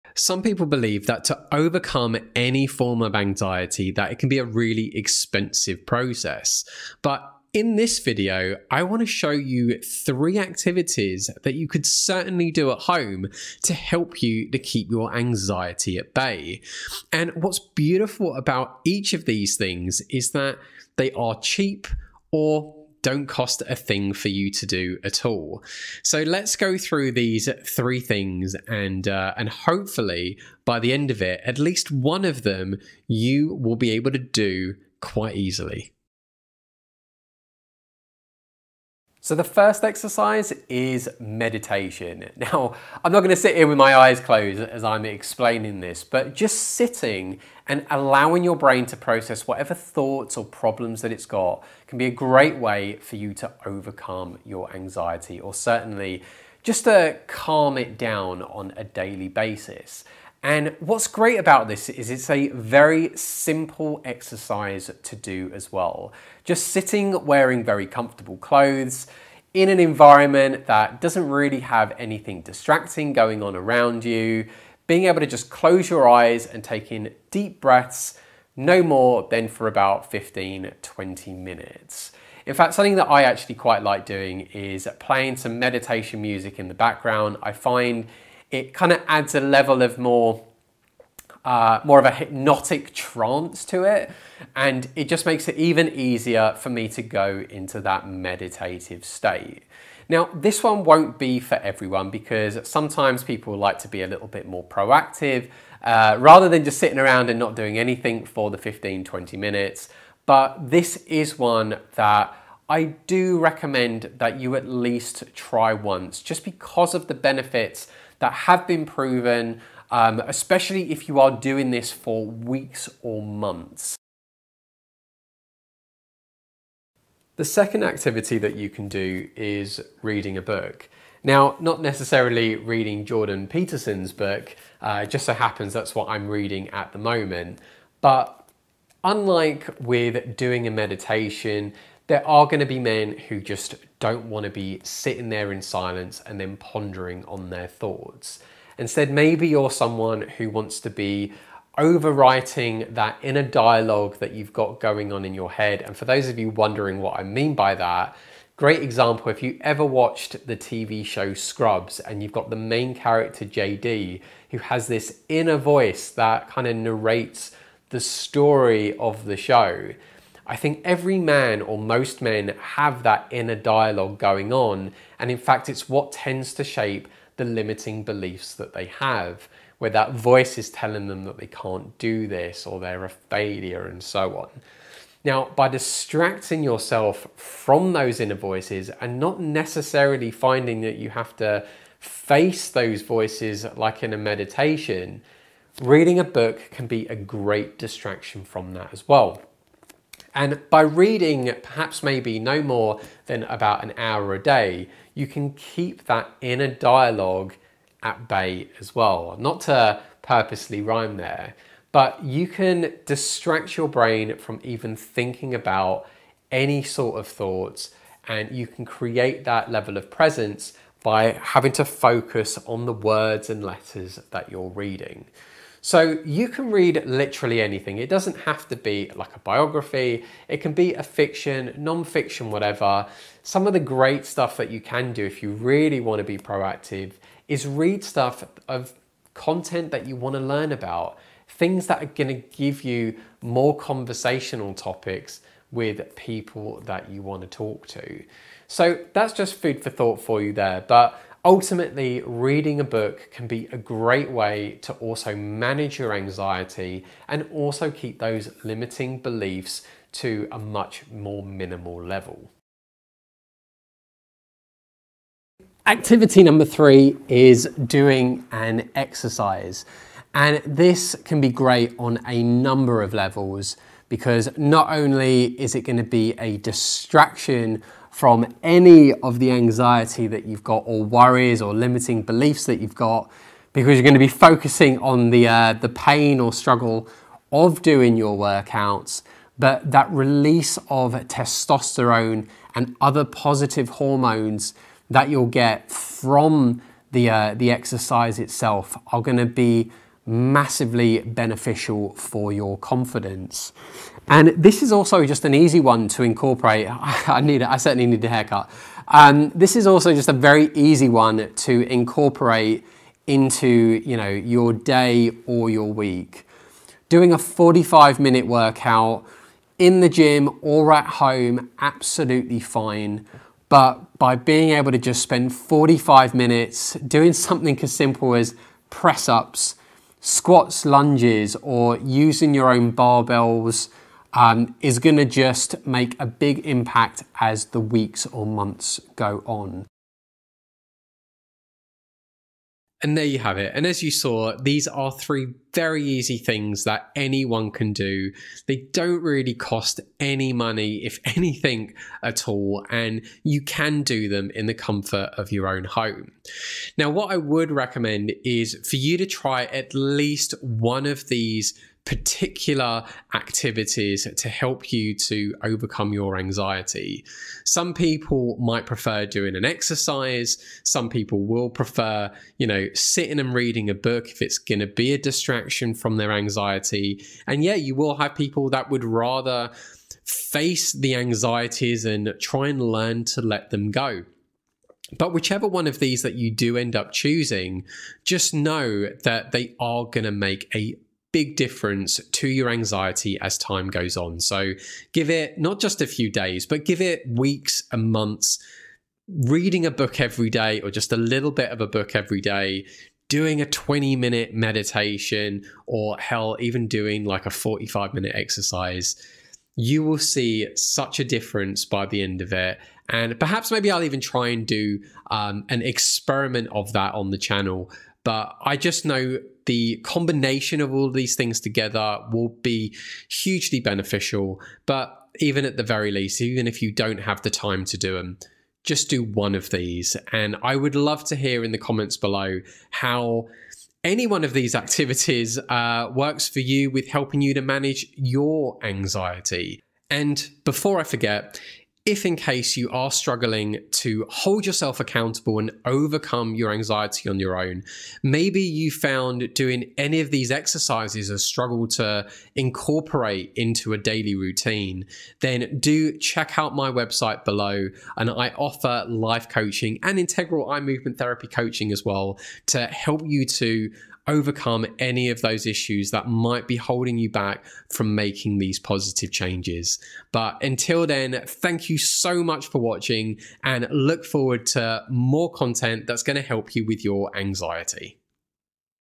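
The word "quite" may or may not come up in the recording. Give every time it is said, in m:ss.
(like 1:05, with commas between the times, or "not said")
0:35, 1:23.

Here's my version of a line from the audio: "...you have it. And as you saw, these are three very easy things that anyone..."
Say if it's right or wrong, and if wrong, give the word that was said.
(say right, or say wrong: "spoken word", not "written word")
right.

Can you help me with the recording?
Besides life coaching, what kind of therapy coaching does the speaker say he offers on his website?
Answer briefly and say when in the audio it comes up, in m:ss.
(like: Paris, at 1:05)
integral eye movement therapy, at 7:40.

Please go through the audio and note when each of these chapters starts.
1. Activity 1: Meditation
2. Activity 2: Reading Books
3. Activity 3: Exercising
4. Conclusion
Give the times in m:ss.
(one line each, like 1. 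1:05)
1. 0:36
2. 2:03
3. 4:22
4. 5:39.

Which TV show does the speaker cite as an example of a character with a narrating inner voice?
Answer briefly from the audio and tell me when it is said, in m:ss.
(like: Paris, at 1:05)
Scrubs, at 2:41.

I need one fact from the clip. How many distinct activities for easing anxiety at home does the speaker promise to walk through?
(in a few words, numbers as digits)
3.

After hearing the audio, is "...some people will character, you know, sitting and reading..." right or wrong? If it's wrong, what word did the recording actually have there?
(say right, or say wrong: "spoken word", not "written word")
wrong: "prefer", not "character".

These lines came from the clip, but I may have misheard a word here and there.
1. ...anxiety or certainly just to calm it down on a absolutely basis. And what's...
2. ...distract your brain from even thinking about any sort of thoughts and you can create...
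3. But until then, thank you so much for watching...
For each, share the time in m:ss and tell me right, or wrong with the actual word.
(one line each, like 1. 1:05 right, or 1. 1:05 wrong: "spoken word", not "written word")
1. 0:54 wrong: "daily", not "absolutely"
2. 3:33 right
3. 7:50 right.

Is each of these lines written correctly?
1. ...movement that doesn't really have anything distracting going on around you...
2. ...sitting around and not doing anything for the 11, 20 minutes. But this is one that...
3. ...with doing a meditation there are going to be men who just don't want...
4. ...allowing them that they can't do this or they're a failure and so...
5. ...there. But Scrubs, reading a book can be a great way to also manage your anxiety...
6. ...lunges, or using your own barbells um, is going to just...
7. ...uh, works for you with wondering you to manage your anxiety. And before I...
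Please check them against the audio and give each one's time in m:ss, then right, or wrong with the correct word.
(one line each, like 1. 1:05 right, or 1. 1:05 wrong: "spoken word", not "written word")
1. 1:09 wrong: "environment", not "movement"
2. 1:46 wrong: "15", not "11"
3. 2:19 right
4. 3:00 wrong: "telling", not "allowing"
5. 4:10 wrong: "Ultimately", not "Scrubs"
6. 5:30 right
7. 7:15 wrong: "helping", not "wondering".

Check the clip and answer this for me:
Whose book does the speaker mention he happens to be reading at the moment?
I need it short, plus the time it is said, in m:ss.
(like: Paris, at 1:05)
Jordan Peterson, at 2:13.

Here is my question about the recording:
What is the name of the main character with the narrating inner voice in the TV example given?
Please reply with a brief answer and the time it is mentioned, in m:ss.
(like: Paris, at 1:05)
JD, at 2:43.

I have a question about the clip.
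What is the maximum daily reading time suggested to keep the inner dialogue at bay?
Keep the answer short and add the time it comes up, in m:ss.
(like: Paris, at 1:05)
about an hour, at 3:23.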